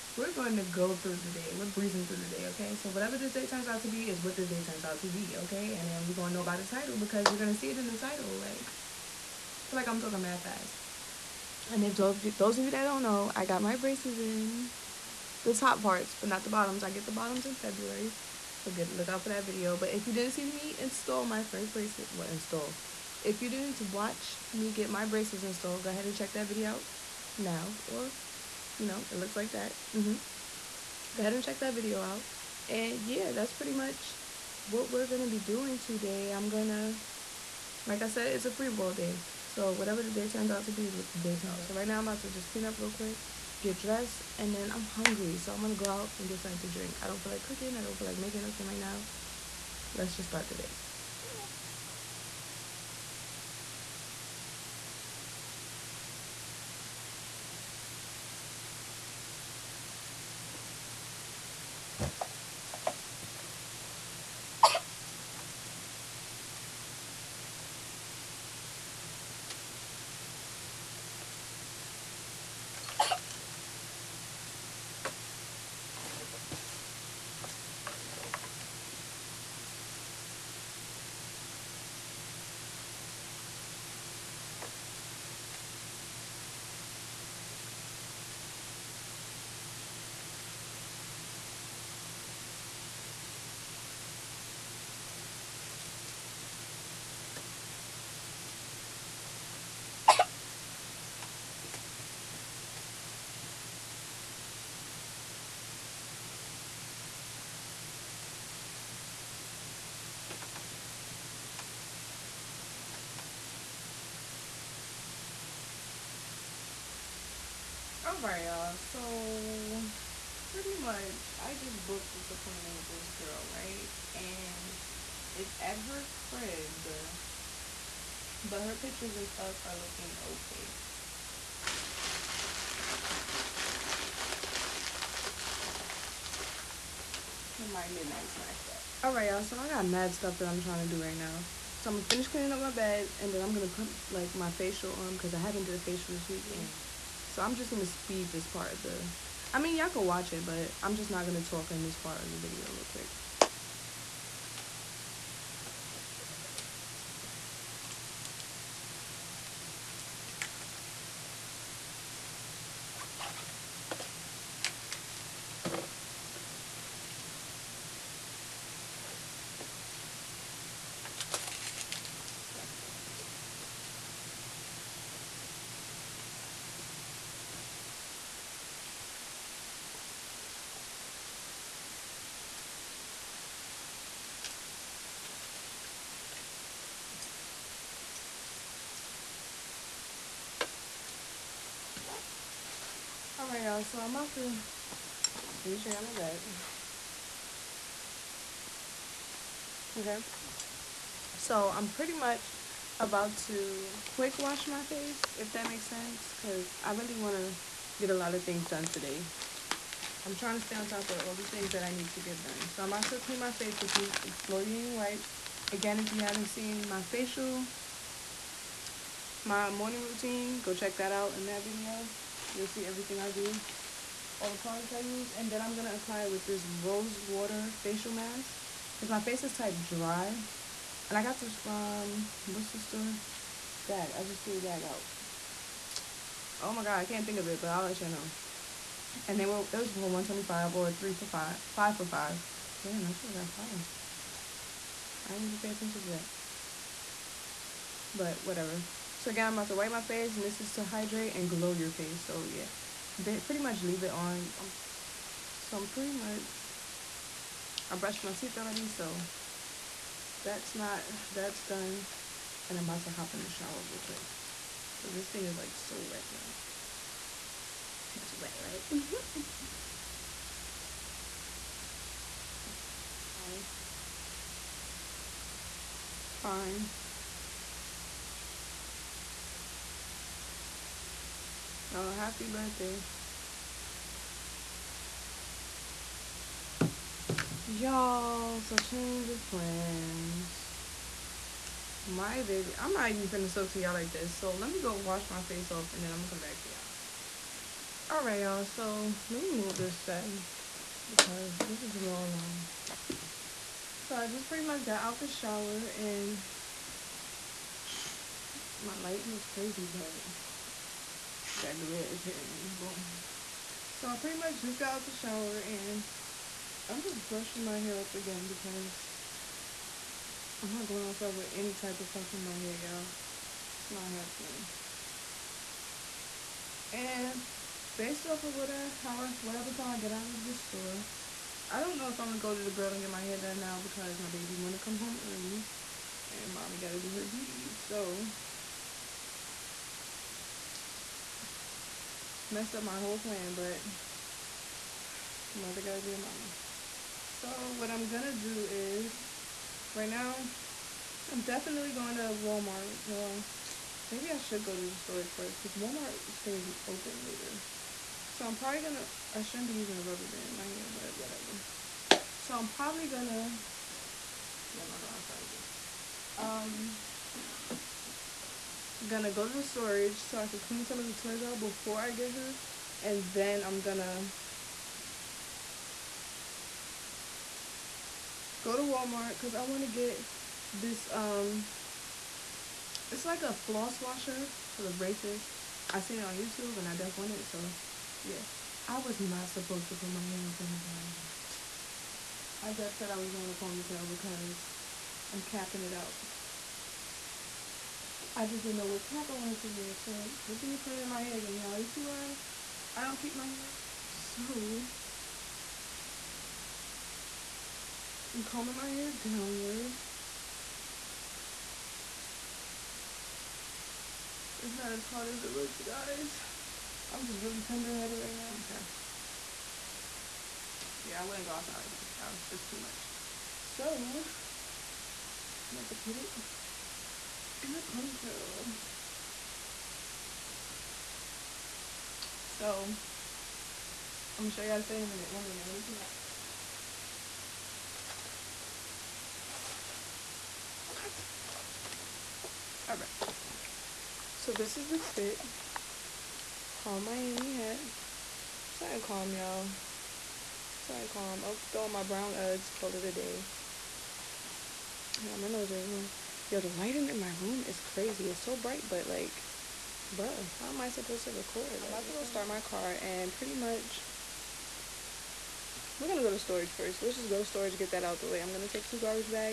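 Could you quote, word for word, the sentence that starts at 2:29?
I mean, y'all can watch it, but I'm just not going to talk in this part of the video real quick.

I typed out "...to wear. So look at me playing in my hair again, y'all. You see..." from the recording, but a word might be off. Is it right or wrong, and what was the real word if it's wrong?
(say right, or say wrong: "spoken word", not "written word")
right.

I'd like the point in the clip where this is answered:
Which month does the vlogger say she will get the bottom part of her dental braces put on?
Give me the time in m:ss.
0:17.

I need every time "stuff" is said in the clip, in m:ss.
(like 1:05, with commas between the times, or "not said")
2:09, 2:20.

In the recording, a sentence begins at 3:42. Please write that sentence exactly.
You'll see everything I do, all the products I use.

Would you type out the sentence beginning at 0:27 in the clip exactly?
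Or, you know, it looks like that.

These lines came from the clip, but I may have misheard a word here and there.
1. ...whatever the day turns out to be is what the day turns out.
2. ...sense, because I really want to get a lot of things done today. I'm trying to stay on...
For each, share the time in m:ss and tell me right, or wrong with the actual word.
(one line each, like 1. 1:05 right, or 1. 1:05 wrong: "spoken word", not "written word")
1. 0:39 right
2. 3:25 right.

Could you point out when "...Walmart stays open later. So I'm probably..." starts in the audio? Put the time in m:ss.
5:55.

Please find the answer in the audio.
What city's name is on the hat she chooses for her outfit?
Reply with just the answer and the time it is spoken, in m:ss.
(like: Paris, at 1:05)
Miami, at 7:27.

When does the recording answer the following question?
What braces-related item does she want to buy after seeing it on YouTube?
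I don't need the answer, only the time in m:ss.
6:23.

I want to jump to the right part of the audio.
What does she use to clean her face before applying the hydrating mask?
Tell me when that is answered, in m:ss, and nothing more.
3:34.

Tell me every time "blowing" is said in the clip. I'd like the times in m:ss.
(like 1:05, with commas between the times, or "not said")
5:01.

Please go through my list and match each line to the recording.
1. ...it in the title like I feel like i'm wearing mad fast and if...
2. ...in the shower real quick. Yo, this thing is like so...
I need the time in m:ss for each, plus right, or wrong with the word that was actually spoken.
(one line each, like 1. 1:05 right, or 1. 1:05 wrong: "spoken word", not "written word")
1. 0:07 wrong: "talking", not "wearing"
2. 4:23 right.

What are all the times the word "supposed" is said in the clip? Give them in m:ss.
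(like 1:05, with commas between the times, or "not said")
6:29, 7:40.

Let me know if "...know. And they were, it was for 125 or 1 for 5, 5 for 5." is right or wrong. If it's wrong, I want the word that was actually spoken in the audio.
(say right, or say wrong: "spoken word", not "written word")
wrong: "3", not "1".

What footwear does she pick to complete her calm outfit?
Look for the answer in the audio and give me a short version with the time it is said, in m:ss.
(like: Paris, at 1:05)
brown Uggs, at 7:32.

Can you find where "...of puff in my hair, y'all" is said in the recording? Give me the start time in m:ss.
5:22.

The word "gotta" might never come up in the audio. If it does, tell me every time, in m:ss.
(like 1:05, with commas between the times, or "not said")
5:36, 5:45.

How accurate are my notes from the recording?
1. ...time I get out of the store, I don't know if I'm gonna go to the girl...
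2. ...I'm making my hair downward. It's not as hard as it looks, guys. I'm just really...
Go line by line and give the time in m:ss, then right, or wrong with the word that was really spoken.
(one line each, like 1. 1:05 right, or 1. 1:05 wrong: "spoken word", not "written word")
1. 5:29 right
2. 6:48 wrong: "combing", not "making".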